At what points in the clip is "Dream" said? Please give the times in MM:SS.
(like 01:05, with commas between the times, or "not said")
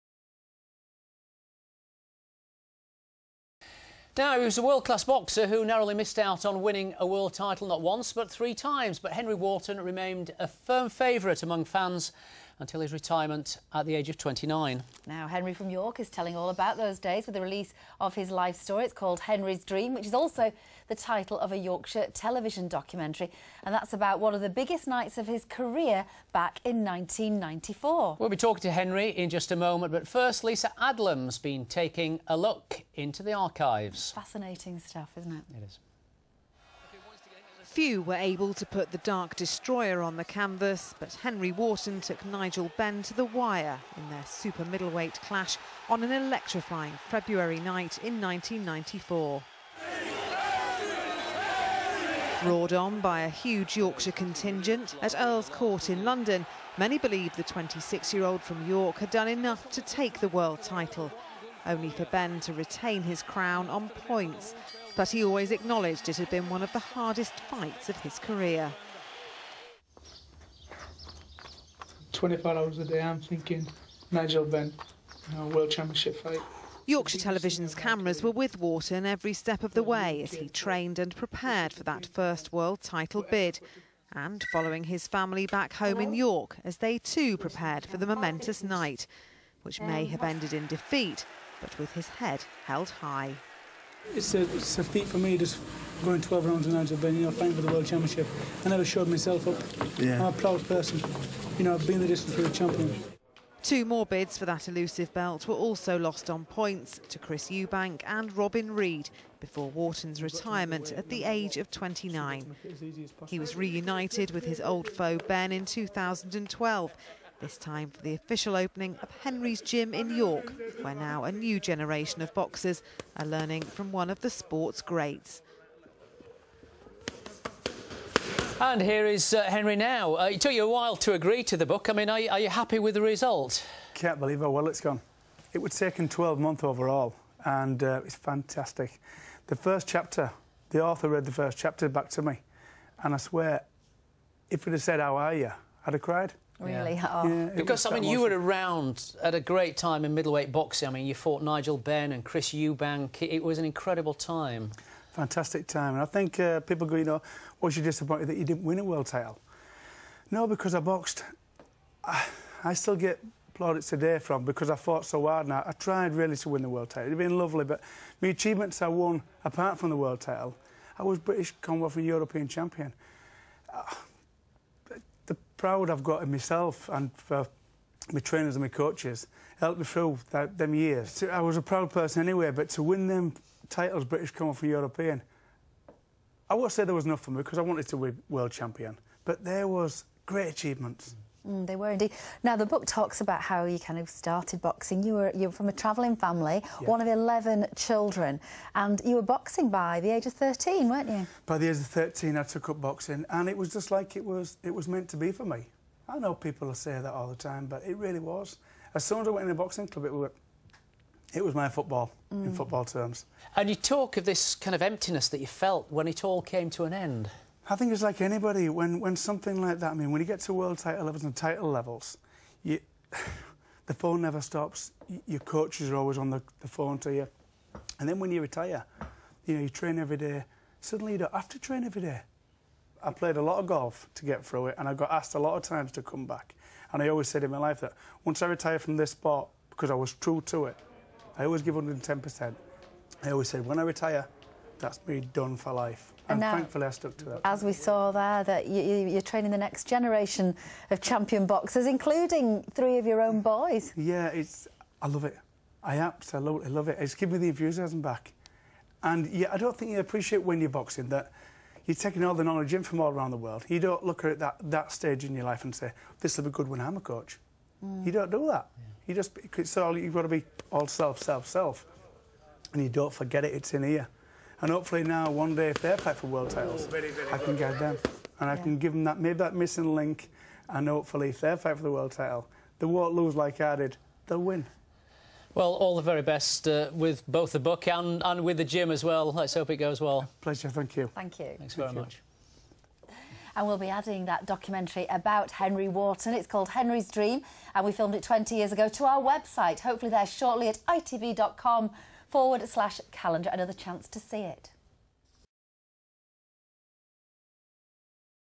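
00:19, 04:57.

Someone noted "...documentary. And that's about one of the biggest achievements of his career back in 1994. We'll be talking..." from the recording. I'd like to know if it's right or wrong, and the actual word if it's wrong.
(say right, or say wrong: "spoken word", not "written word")
wrong: "nights", not "achievements".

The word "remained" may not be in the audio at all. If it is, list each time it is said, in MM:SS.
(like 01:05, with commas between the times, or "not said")
00:09.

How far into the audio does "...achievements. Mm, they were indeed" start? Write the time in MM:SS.
03:10.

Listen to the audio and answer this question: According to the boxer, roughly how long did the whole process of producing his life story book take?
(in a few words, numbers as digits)
12 months.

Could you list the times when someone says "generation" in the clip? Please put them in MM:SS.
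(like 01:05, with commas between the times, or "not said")
02:01, 04:09.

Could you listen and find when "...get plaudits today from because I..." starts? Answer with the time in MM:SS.
02:42.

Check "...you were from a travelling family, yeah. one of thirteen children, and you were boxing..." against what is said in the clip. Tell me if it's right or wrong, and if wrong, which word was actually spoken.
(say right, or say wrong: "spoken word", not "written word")
wrong: "eleven", not "thirteen".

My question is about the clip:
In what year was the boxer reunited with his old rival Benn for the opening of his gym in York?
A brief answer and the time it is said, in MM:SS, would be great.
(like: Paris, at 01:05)
2012, at 01:55.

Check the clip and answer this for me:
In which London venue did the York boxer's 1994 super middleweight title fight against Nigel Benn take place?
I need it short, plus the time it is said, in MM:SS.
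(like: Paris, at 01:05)
Earl's Court, at 00:55.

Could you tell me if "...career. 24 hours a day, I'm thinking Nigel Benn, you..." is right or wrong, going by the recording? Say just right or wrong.
right.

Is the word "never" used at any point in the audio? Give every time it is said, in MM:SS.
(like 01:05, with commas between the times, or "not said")
01:38, 03:44.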